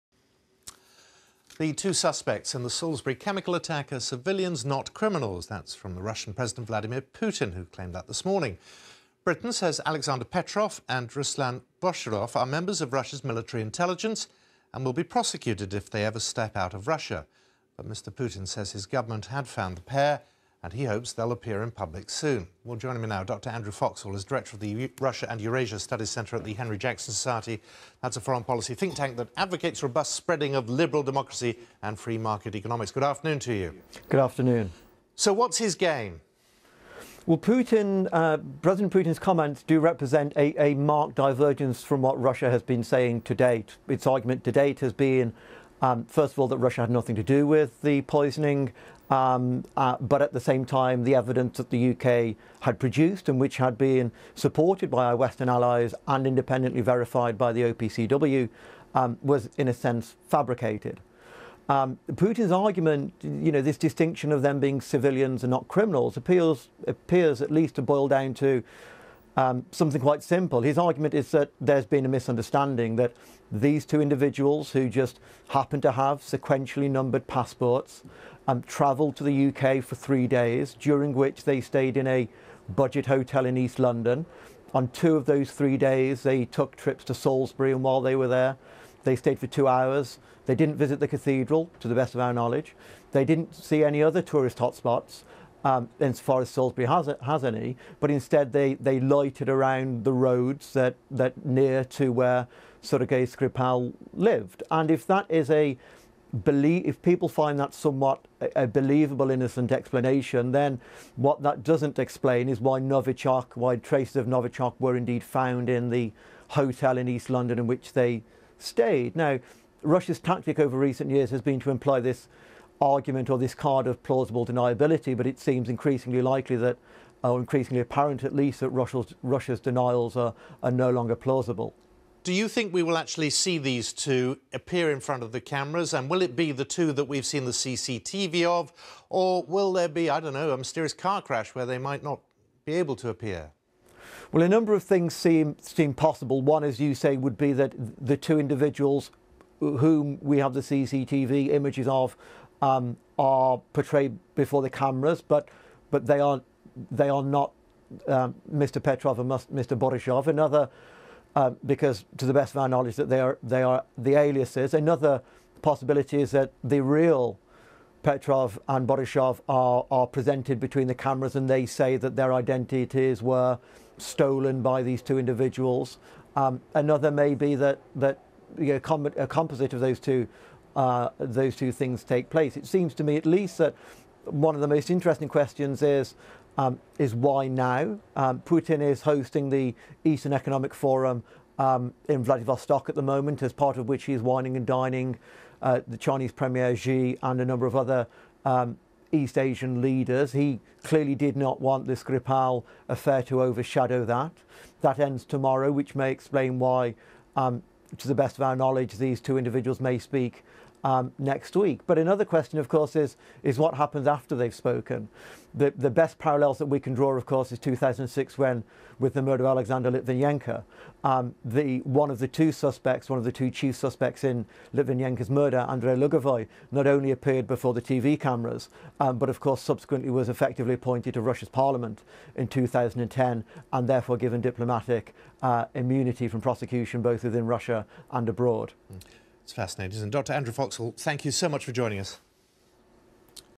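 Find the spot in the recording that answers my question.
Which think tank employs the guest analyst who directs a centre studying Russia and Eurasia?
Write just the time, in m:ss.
0:26.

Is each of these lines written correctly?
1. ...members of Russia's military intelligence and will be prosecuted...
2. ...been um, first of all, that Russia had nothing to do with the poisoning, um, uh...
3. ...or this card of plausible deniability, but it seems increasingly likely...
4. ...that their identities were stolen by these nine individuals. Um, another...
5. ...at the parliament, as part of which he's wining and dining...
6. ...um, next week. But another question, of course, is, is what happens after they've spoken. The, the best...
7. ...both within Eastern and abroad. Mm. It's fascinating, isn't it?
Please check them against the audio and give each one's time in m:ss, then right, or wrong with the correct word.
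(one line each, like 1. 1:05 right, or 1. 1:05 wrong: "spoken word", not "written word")
1. 0:12 right
2. 0:44 right
3. 2:03 right
4. 2:51 wrong: "two", not "nine"
5. 3:12 wrong: "moment", not "parliament"
6. 3:30 right
7. 3:57 wrong: "Russia", not "Eastern".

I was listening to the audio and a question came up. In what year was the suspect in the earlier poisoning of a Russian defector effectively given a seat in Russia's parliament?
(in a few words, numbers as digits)
2010.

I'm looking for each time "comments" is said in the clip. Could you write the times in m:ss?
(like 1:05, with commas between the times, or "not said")
0:39.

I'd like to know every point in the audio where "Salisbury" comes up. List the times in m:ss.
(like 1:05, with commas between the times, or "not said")
0:02, 1:27, 1:36.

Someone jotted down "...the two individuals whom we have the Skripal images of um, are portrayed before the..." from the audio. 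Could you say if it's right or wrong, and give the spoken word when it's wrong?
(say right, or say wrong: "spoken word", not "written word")
wrong: "CCTV", not "Skripal".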